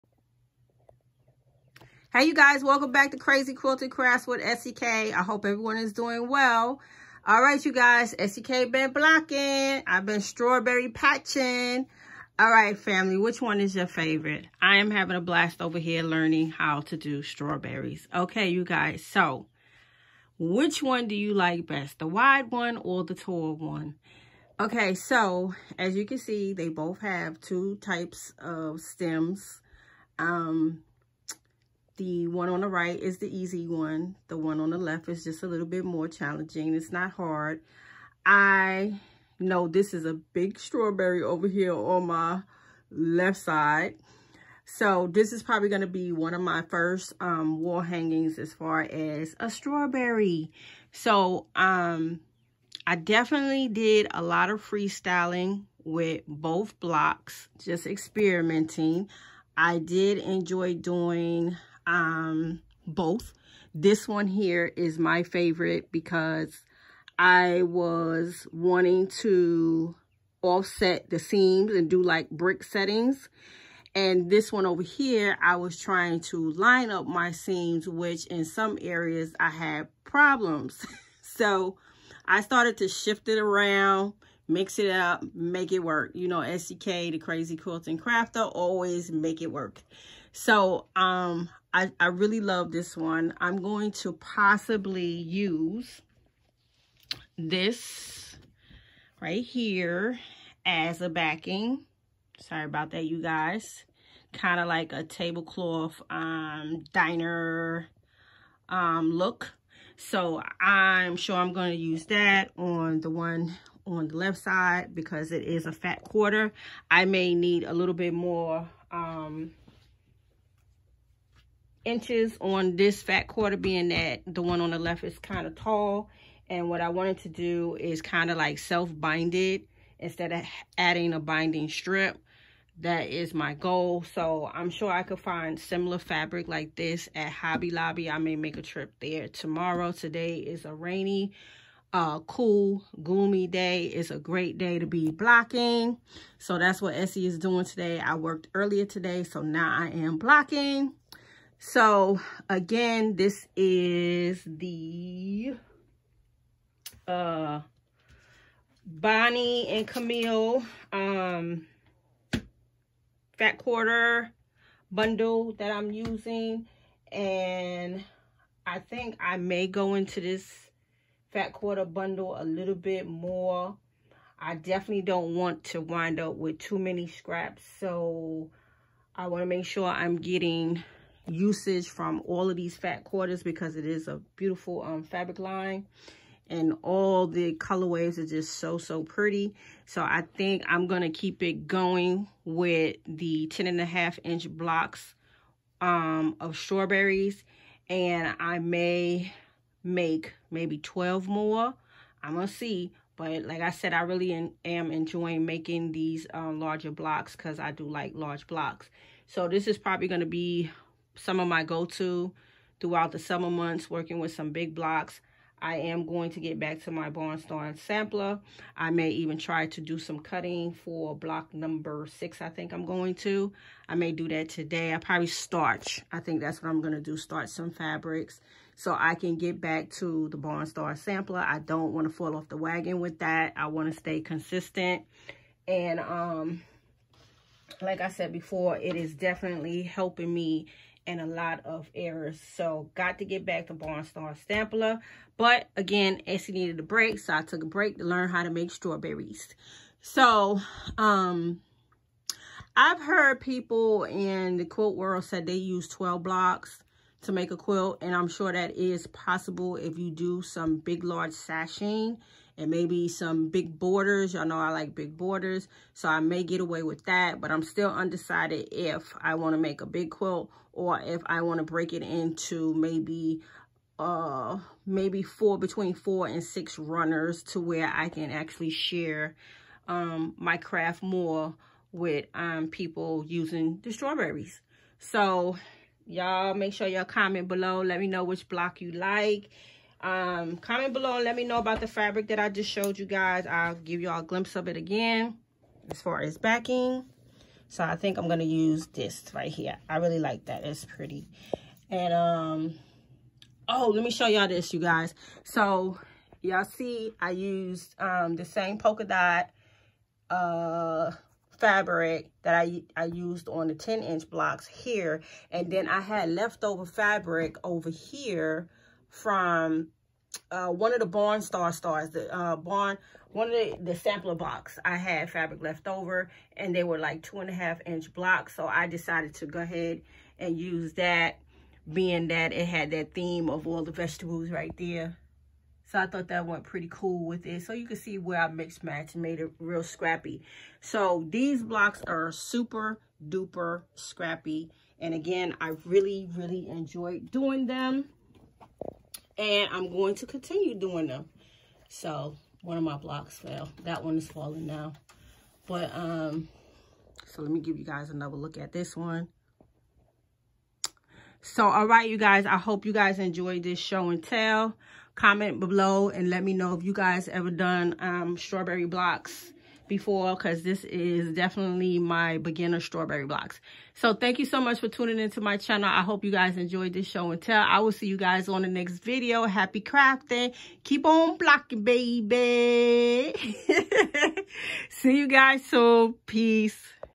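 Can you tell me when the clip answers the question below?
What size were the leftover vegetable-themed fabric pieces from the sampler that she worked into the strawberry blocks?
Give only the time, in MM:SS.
05:27.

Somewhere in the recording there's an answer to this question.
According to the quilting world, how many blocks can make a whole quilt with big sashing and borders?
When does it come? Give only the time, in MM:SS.
04:15.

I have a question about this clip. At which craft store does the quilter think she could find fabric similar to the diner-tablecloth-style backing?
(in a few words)
Hobby Lobby.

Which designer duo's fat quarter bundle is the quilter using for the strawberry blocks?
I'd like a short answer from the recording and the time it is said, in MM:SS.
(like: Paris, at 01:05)
Bonnie and Camille, at 02:38.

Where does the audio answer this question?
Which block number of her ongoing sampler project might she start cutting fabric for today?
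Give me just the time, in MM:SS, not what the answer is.
03:41.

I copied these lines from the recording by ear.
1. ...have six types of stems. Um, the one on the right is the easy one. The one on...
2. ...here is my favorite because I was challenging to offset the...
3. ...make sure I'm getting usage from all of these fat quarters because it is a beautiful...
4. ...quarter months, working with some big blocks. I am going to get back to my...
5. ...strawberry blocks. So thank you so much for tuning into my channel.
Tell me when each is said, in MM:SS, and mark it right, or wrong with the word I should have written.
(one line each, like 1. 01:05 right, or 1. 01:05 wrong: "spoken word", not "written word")
1. 00:26 wrong: "two", not "six"
2. 01:04 wrong: "wanting", not "challenging"
3. 02:59 right
4. 03:33 wrong: "summer", not "quarter"
5. 06:12 right.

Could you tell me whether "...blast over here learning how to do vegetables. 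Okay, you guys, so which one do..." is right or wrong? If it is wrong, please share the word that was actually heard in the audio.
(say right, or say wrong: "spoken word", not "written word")
wrong: "strawberries", not "vegetables".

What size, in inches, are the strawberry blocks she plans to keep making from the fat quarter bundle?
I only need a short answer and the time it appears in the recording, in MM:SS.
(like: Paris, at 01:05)
10 and a half inch, at 03:13.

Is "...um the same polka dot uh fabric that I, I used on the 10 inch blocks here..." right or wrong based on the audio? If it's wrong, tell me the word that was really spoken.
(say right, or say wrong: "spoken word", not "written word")
right.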